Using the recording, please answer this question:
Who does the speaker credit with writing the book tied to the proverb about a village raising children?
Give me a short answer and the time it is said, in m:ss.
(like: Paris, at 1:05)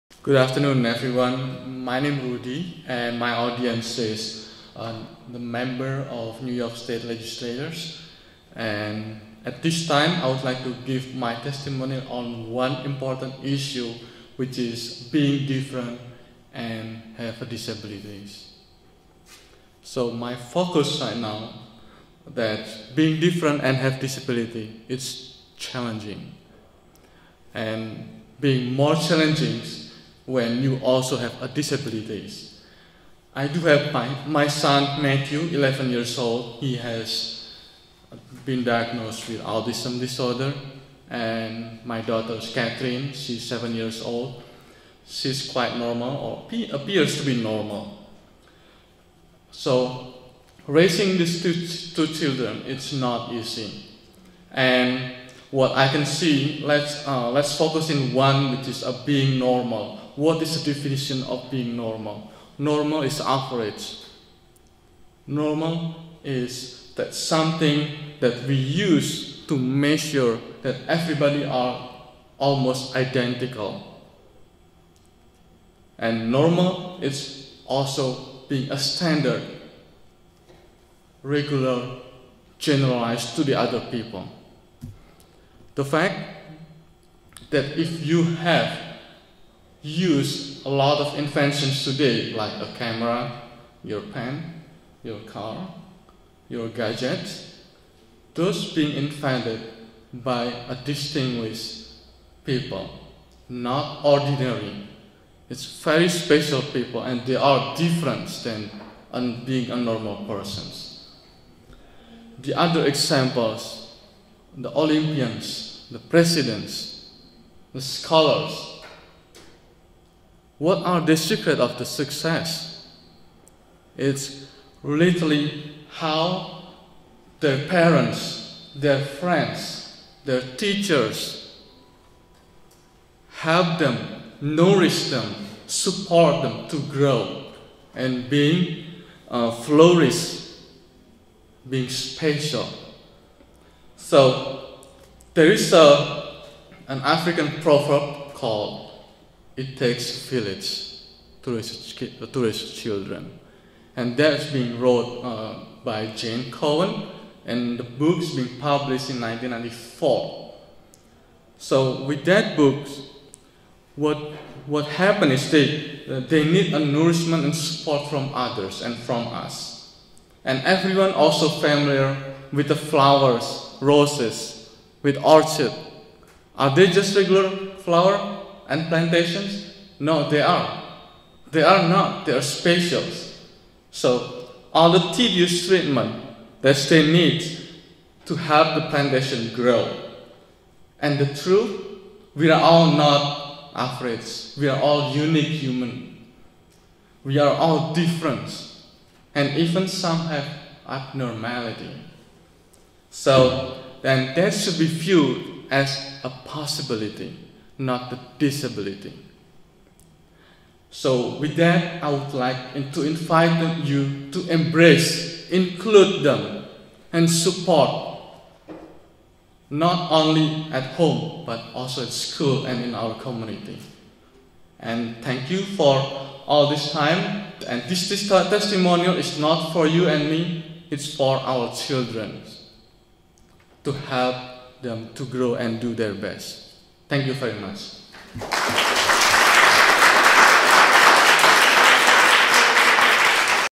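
Jane Cowen, at 2:36.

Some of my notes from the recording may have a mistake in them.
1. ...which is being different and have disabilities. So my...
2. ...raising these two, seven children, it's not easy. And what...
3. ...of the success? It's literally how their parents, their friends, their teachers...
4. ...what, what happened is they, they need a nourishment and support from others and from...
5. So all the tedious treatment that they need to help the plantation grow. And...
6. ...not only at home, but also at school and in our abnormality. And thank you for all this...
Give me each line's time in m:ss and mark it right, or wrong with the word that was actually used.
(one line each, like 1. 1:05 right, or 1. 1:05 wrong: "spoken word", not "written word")
1. 0:14 right
2. 0:50 wrong: "two", not "seven"
3. 2:01 right
4. 2:43 right
5. 3:03 right
6. 3:39 wrong: "community", not "abnormality".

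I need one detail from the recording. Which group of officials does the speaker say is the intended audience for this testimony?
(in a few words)
New York State legislators.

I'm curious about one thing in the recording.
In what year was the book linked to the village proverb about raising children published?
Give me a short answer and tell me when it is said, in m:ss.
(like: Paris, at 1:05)
1994, at 2:39.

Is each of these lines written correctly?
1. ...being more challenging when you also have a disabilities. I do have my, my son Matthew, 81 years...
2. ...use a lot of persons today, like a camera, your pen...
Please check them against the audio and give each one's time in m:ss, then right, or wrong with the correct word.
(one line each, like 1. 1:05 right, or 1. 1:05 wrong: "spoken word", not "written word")
1. 0:28 wrong: "11", not "81"
2. 1:29 wrong: "inventions", not "persons".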